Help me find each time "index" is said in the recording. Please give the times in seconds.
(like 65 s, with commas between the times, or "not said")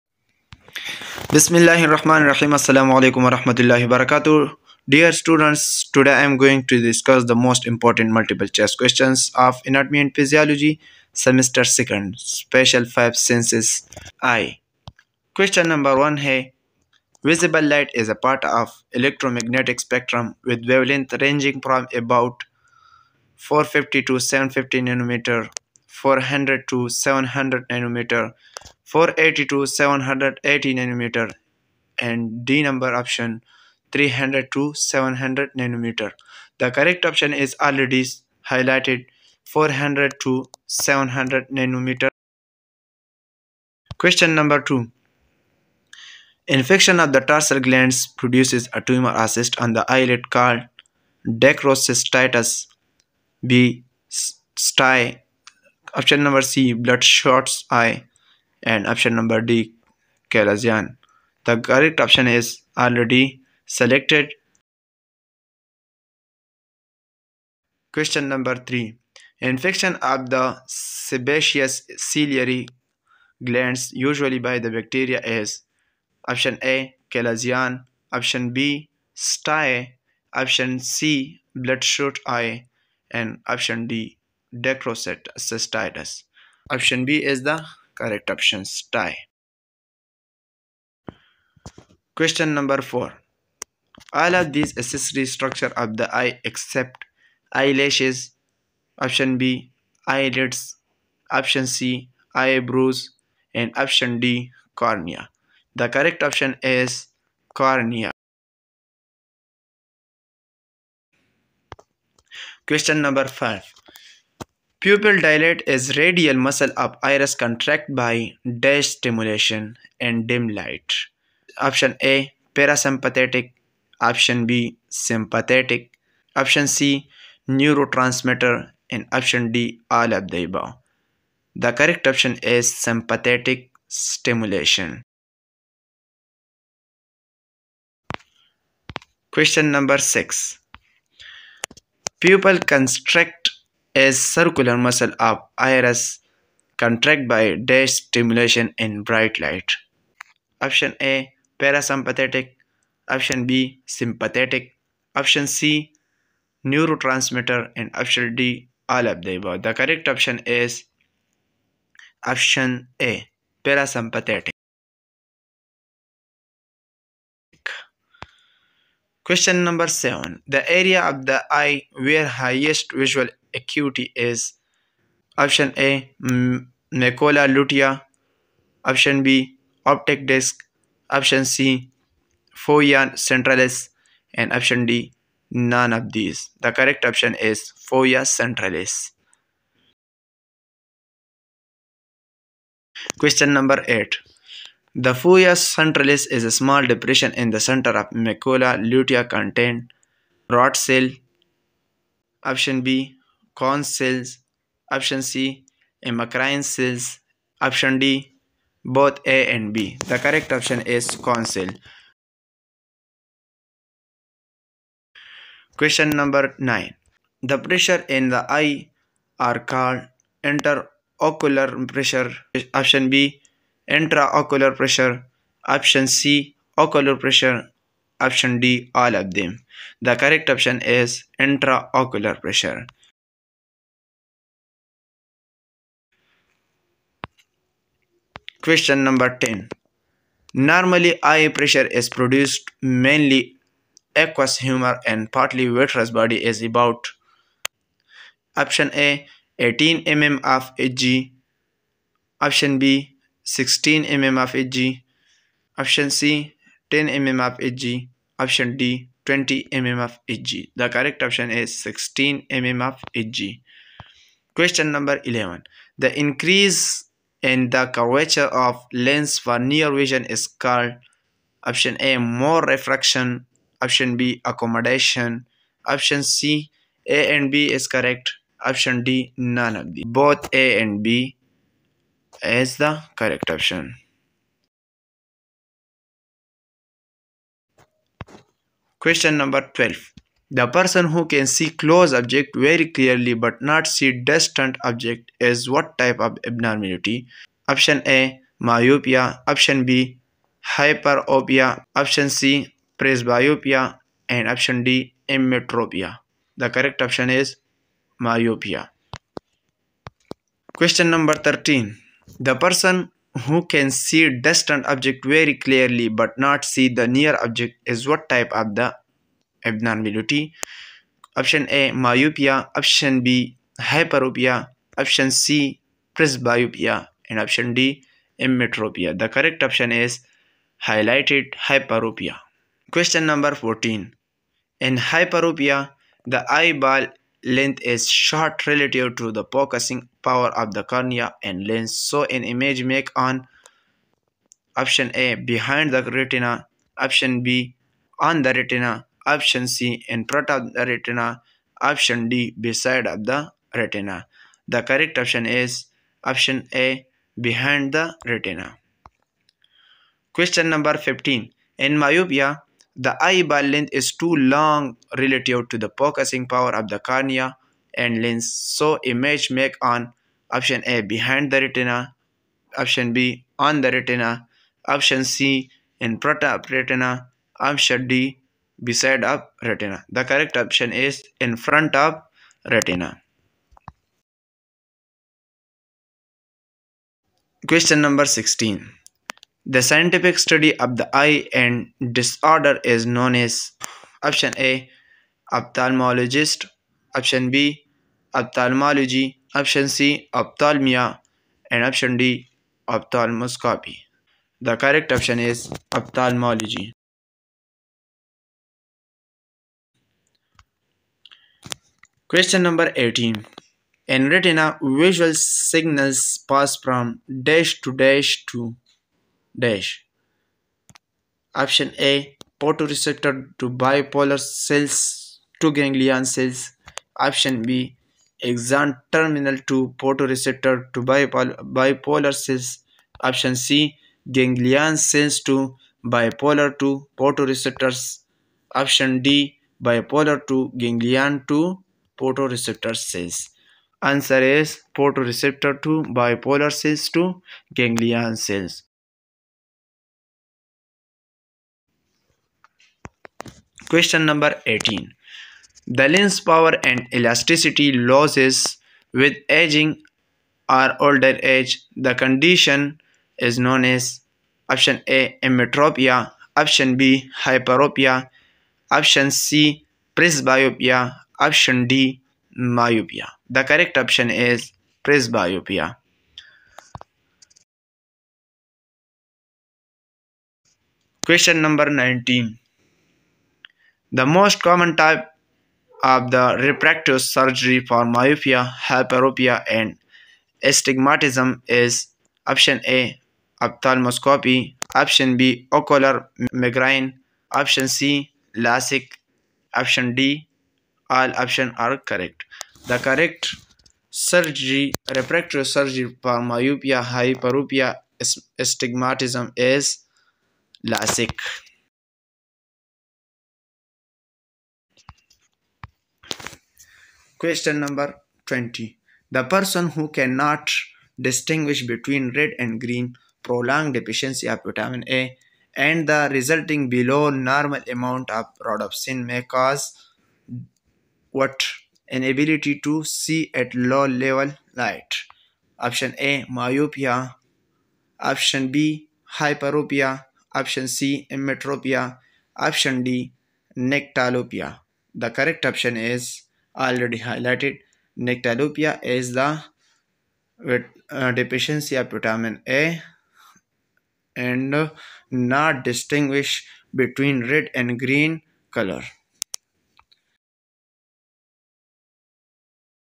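not said.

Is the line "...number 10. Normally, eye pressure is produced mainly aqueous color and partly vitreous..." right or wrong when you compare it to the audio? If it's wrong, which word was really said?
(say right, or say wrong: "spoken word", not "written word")
wrong: "humor", not "color".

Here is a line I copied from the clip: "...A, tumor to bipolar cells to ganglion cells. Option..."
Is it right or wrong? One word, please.
wrong.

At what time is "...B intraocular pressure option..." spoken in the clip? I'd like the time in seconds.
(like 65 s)
223 s.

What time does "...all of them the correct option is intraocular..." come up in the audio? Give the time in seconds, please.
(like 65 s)
229 s.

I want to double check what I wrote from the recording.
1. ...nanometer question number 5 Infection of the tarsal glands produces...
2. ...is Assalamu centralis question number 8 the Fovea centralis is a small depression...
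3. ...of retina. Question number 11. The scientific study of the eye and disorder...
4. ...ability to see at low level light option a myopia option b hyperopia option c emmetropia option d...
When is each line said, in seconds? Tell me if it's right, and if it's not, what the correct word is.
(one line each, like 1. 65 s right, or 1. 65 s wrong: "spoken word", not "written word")
1. 41 s wrong: "2", not "5"
2. 187 s wrong: "Fovea", not "Assalamu"
3. 381 s wrong: "16", not "11"
4. 532 s right.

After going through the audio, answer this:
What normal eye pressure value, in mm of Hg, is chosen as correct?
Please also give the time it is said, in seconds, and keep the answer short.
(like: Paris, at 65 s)
16 mm Hg, at 260 s.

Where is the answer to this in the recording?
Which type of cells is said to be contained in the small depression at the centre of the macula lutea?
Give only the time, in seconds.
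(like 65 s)
210 s.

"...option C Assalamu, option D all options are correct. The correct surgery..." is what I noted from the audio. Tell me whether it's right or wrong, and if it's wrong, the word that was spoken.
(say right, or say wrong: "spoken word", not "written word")
wrong: "LASIK", not "Assalamu".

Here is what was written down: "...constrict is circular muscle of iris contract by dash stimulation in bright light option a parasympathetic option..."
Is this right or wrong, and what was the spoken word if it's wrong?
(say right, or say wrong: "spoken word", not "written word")
right.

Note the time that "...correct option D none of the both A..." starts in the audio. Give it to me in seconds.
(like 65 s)
277 s.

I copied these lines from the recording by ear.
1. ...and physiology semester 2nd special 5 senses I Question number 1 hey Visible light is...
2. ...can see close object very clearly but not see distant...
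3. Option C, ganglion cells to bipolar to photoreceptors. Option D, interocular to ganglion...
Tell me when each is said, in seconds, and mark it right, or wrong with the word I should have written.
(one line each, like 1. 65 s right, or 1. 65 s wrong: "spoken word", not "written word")
1. 10 s right
2. 291 s right
3. 433 s wrong: "bipolar", not "interocular".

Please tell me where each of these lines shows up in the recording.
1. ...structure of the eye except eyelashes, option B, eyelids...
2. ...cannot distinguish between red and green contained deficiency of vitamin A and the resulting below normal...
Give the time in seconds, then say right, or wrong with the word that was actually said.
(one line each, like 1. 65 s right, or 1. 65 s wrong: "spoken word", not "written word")
1. 95 s right
2. 520 s wrong: "prolonged", not "contained".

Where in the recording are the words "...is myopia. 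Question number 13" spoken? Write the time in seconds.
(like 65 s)
307 s.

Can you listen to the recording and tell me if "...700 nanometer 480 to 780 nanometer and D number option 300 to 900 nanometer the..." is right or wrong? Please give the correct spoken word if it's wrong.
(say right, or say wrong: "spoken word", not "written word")
wrong: "700", not "900".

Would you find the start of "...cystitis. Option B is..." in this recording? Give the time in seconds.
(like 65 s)
85 s.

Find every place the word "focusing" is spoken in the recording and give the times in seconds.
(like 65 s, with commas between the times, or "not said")
339 s, 365 s.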